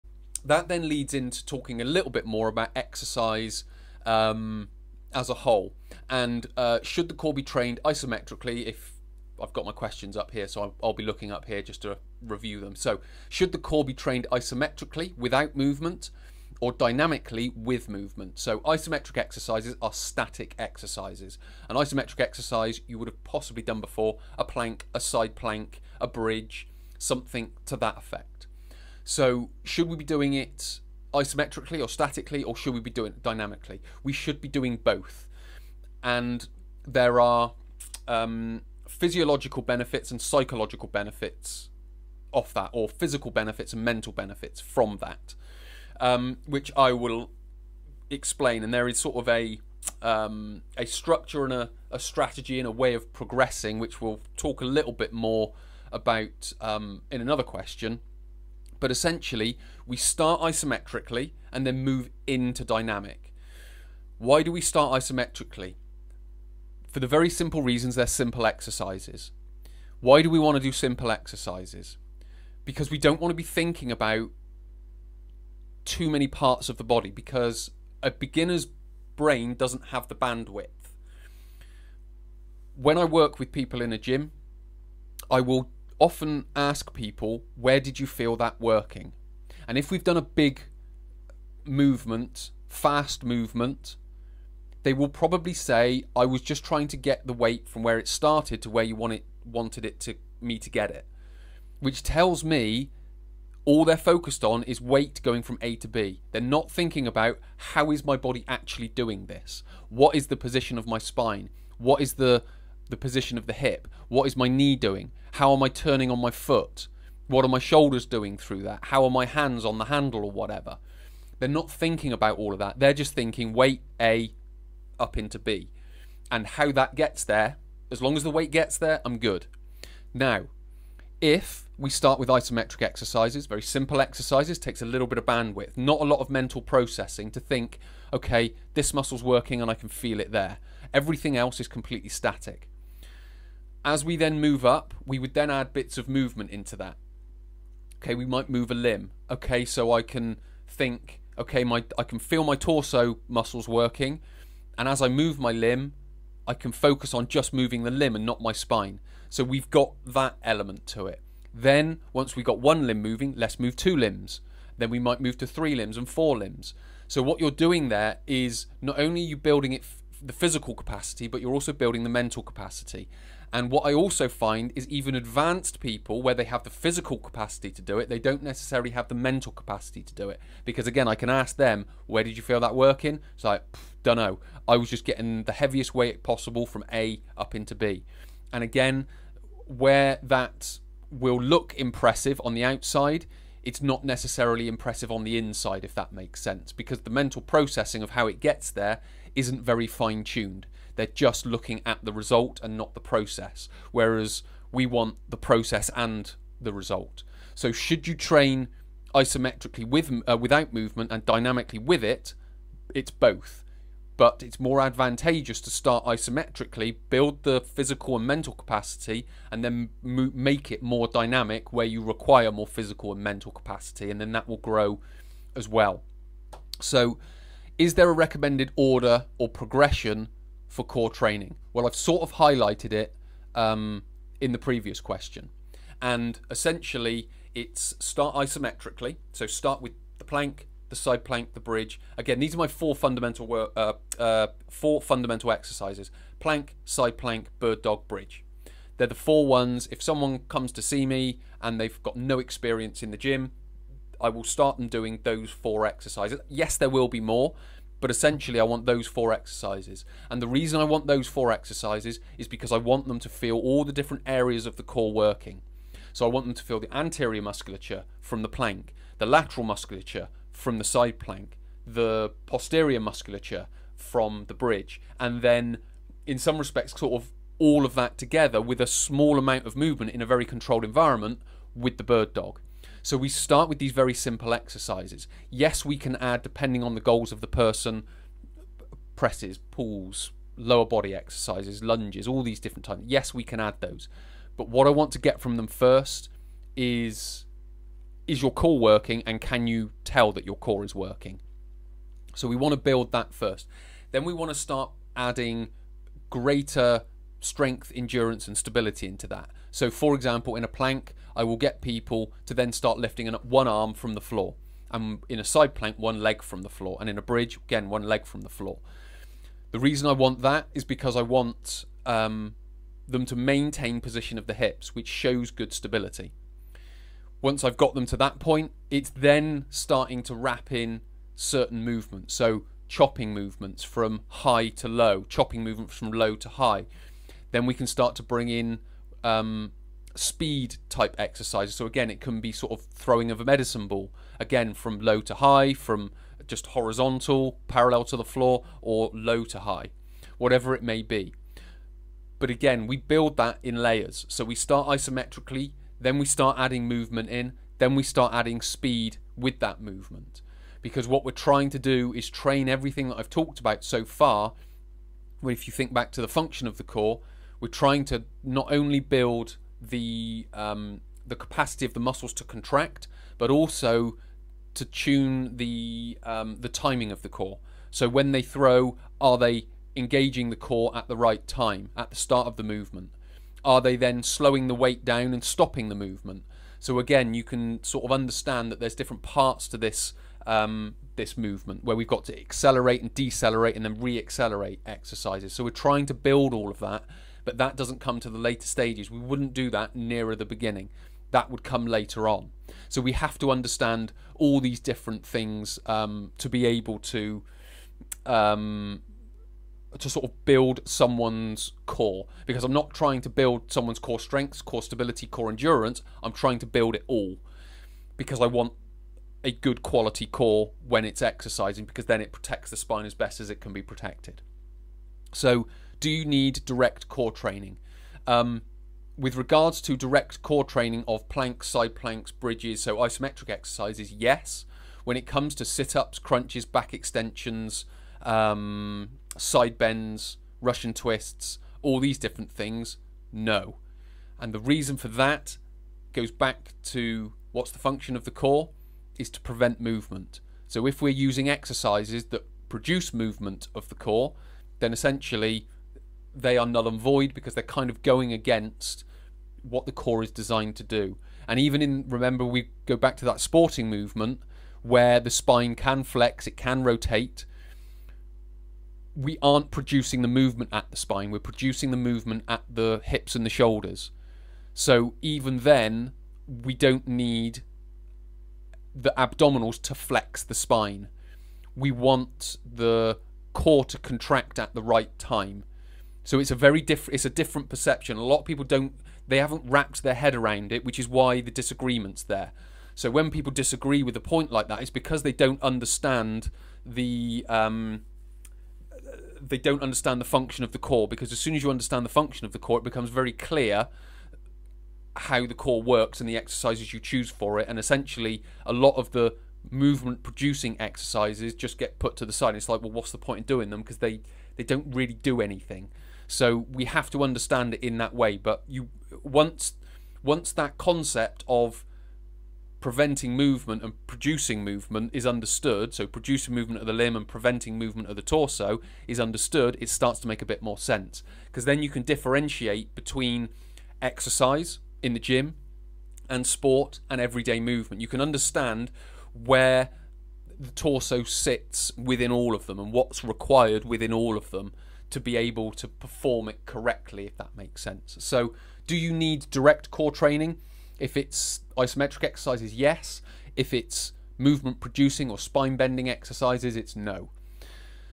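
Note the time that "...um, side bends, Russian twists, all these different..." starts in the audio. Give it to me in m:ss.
7:18.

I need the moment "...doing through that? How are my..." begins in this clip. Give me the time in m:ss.
1:58.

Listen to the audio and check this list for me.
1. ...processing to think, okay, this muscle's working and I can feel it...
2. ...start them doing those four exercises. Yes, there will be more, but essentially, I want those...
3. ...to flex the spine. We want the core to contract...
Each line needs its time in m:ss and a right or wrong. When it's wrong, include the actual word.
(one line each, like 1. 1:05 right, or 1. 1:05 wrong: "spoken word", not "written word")
1. 2:16 right
2. 4:14 right
3. 7:59 right.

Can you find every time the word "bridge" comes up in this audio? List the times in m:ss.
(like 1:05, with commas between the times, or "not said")
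0:26, 4:01, 4:08, 4:34, 5:17, 7:12.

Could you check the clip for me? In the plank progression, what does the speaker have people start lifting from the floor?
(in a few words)
One arm.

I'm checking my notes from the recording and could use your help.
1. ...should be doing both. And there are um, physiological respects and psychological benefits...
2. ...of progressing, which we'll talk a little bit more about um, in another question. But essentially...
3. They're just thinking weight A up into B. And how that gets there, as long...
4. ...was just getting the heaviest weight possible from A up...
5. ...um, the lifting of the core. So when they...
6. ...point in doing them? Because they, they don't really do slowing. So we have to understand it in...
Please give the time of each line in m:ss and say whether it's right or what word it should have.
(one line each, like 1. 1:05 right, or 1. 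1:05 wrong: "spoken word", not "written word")
1. 0:34 wrong: "benefits", not "respects"
2. 0:52 right
3. 2:02 right
4. 3:04 right
5. 6:16 wrong: "timing", not "lifting"
6. 8:33 wrong: "anything", not "slowing".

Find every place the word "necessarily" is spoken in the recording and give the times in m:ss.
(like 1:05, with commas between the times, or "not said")
2:58, 3:14.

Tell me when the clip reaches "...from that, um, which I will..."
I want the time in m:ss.
0:44.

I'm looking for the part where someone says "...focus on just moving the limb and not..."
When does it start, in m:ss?
2:36.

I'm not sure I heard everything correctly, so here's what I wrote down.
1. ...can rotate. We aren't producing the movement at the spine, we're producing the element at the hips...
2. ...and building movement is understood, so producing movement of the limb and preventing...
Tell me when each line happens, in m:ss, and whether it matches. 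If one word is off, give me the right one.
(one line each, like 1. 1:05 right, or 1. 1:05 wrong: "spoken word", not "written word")
1. 7:46 wrong: "movement", not "element"
2. 8:43 wrong: "producing", not "building".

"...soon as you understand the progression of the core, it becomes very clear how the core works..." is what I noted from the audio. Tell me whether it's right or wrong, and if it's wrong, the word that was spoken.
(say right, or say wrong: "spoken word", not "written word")
wrong: "function", not "progression".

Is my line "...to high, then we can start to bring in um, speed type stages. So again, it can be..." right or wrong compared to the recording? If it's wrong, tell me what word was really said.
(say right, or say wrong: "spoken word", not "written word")
wrong: "exercises", not "stages".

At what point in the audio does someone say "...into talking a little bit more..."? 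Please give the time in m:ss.
0:01.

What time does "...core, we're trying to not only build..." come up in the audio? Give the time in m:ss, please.
6:06.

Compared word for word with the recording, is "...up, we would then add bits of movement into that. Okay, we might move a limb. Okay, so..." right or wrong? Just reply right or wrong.
right.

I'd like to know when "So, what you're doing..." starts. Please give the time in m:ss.
2:47.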